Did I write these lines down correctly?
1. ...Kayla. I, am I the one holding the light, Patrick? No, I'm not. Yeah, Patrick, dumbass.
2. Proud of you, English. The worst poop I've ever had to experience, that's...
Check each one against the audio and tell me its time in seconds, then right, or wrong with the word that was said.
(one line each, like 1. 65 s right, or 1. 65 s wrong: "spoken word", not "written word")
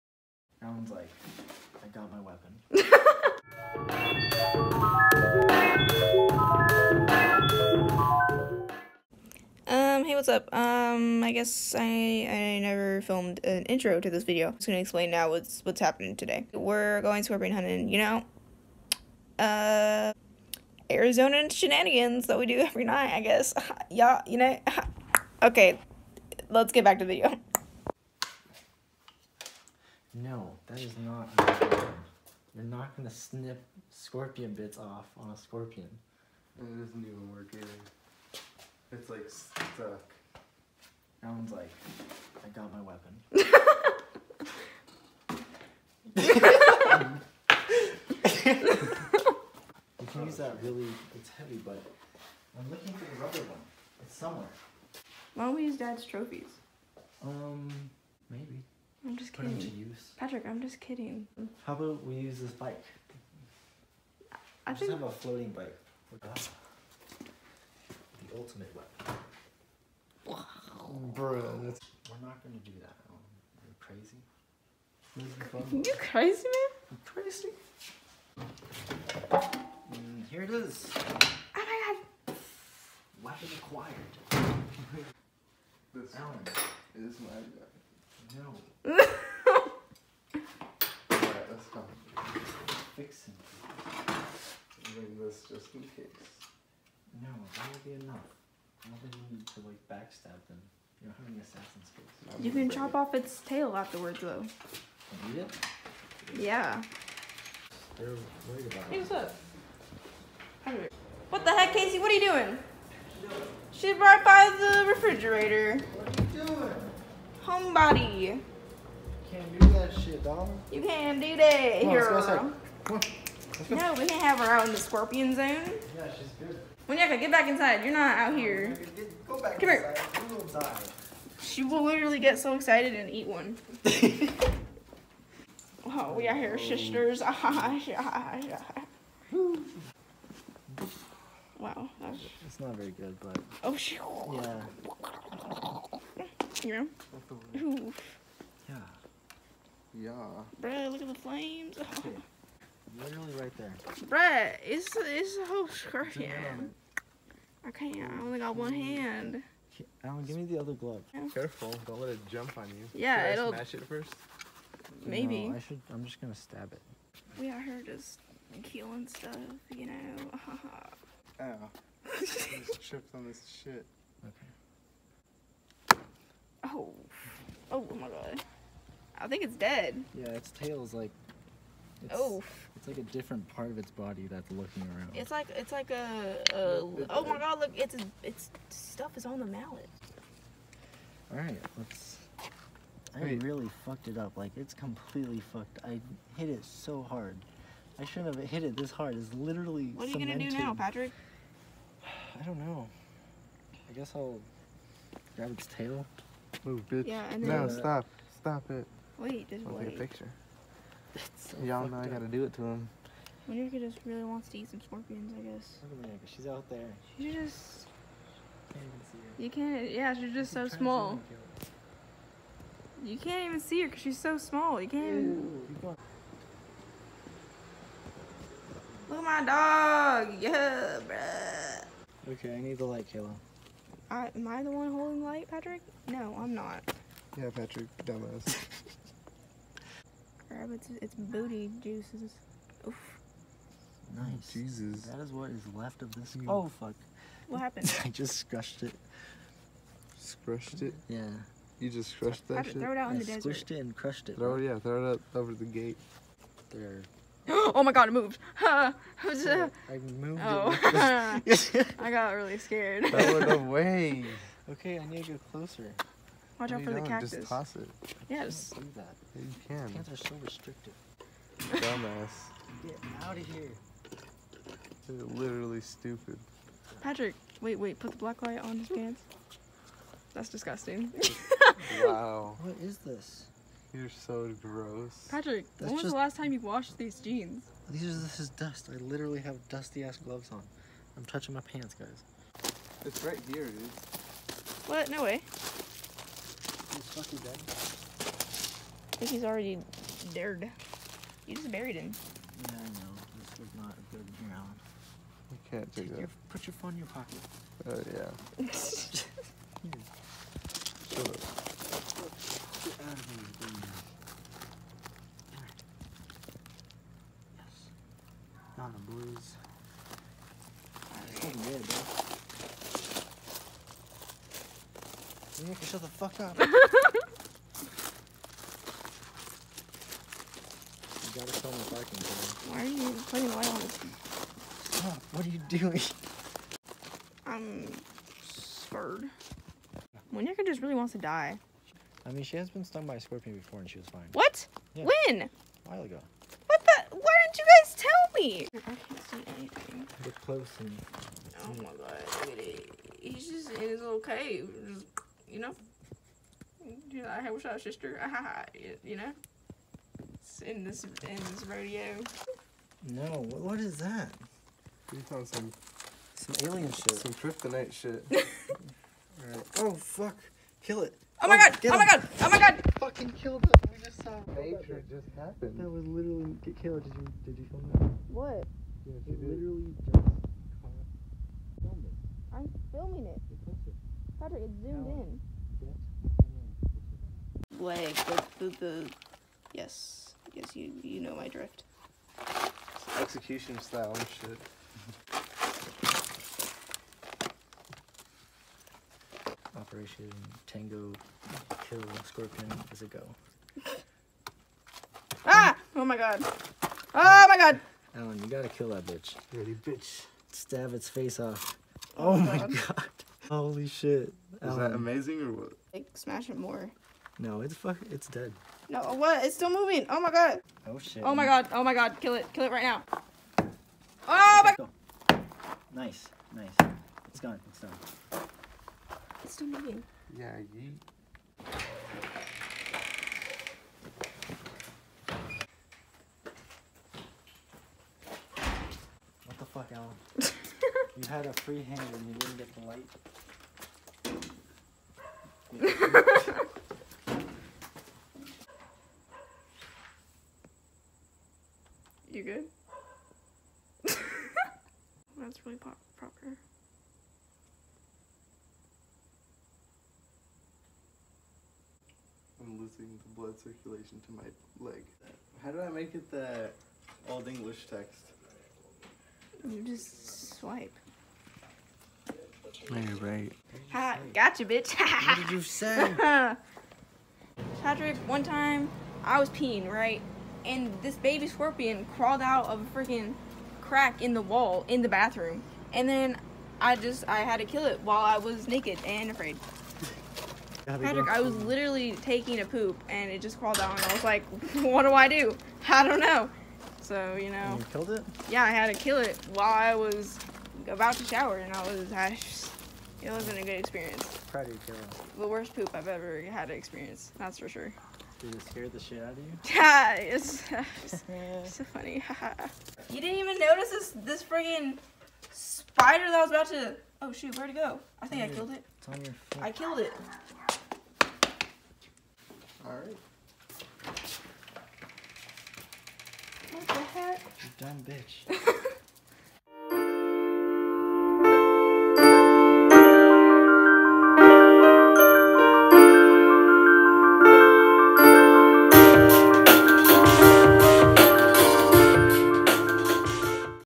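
1. 233 s right
2. 504 s wrong: "Kayla", not "English".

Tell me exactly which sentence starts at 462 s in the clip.
the blood circulation to my leg.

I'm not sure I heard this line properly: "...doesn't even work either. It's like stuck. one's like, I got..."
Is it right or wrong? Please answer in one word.
right.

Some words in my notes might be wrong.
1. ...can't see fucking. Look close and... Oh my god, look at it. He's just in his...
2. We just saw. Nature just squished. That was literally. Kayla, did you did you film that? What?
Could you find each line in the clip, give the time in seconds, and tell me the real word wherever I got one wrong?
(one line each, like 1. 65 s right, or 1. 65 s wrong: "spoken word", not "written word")
1. 348 s wrong: "anything", not "fucking"
2. 373 s wrong: "happened", not "squished".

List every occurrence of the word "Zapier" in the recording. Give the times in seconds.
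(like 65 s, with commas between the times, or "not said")
not said.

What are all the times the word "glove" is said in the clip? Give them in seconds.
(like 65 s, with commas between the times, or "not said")
160 s, 290 s.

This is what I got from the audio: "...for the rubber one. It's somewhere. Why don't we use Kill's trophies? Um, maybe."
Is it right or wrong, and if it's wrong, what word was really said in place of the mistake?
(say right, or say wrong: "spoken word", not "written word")
wrong: "Dad", not "Kill".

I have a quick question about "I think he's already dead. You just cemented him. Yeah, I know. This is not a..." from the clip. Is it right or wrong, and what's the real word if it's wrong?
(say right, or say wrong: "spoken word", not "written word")
wrong: "buried", not "cemented".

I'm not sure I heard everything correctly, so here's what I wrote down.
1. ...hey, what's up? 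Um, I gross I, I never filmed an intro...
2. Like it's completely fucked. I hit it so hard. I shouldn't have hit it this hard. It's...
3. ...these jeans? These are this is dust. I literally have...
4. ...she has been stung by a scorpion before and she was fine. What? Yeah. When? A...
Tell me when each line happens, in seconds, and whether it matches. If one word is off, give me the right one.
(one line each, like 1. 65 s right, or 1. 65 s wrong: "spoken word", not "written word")
1. 10 s wrong: "guess", not "gross"
2. 194 s right
3. 286 s right
4. 342 s right.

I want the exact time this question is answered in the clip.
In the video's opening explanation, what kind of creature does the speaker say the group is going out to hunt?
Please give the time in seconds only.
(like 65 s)
17 s.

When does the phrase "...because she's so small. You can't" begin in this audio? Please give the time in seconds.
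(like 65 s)
223 s.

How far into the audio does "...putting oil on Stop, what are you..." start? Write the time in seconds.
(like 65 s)
333 s.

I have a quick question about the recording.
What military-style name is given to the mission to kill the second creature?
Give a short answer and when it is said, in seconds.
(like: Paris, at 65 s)
Operation Tango Kill Scorpion, at 399 s.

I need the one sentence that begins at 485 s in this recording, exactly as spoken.
And then I just, I had to kill it while I was naked and afraid.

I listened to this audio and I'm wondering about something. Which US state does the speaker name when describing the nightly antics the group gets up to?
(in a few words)
Arizona.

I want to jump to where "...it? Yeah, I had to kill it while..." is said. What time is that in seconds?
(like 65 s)
498 s.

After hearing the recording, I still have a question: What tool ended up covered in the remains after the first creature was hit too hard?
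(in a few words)
Mallet.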